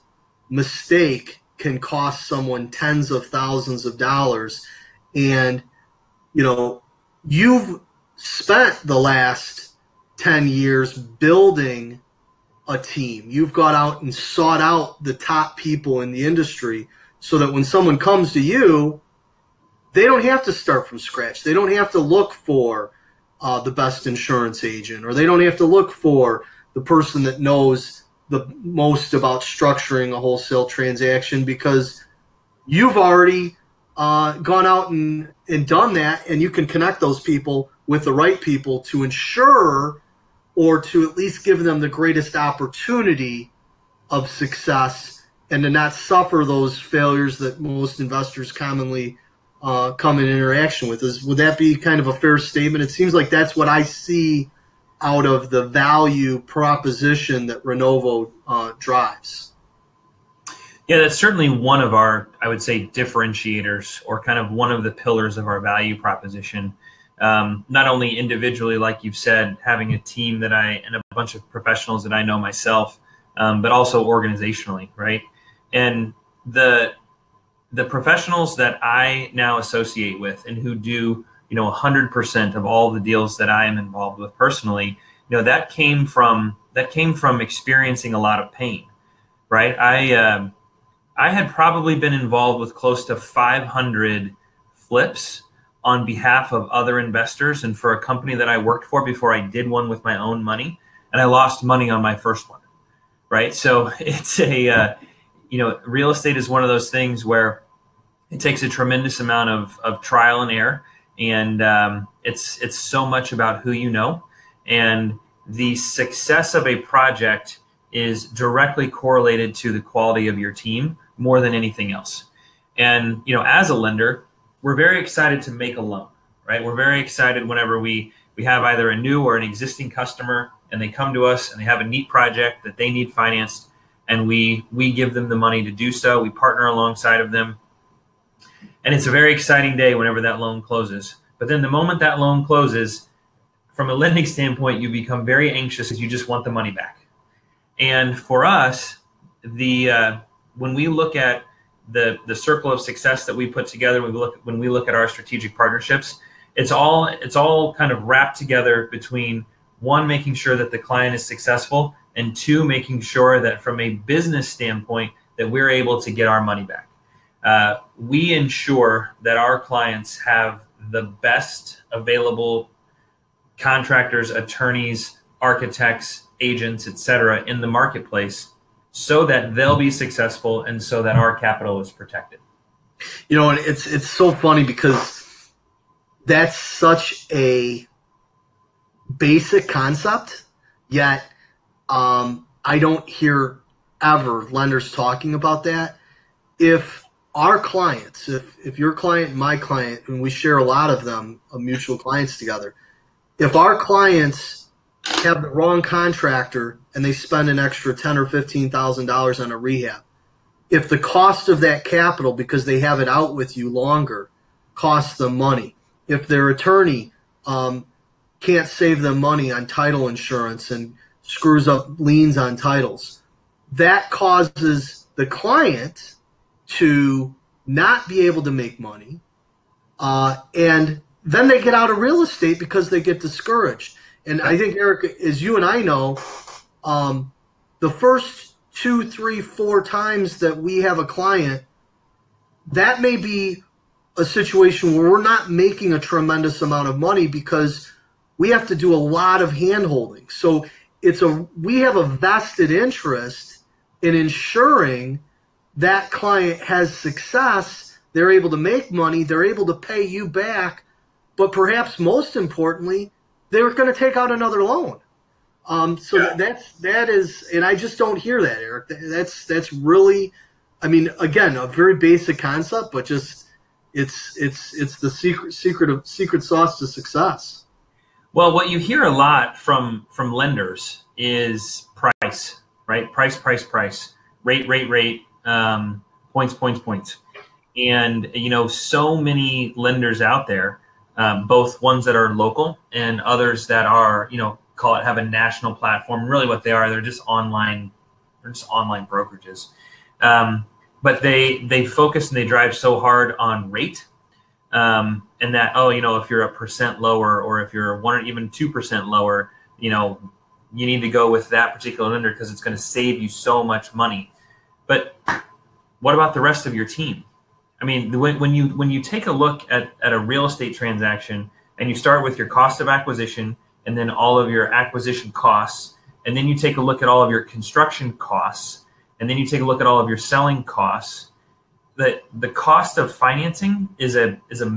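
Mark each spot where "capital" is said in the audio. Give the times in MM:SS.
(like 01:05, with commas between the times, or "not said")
03:01, 03:31.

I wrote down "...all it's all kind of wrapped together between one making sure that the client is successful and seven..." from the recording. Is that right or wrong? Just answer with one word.
wrong.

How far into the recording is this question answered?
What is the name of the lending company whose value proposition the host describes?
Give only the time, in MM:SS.
00:57.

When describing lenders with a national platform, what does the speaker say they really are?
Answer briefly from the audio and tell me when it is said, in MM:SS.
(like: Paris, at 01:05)
online brokerages, at 04:58.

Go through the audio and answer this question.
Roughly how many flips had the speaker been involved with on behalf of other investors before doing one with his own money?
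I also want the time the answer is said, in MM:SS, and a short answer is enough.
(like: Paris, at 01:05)
500, at 01:33.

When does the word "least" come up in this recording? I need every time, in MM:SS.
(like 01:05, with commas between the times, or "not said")
00:41.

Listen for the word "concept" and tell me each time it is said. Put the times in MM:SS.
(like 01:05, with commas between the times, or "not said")
03:09, 04:32.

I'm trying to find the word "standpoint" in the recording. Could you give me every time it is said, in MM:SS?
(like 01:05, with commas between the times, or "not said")
02:24, 02:44.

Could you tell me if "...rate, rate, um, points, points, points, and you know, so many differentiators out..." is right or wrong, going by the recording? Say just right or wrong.
wrong.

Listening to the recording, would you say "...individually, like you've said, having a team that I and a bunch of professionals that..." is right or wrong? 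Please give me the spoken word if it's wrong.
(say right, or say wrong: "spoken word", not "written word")
right.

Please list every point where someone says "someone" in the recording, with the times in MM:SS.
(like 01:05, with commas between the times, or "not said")
00:02, 00:17.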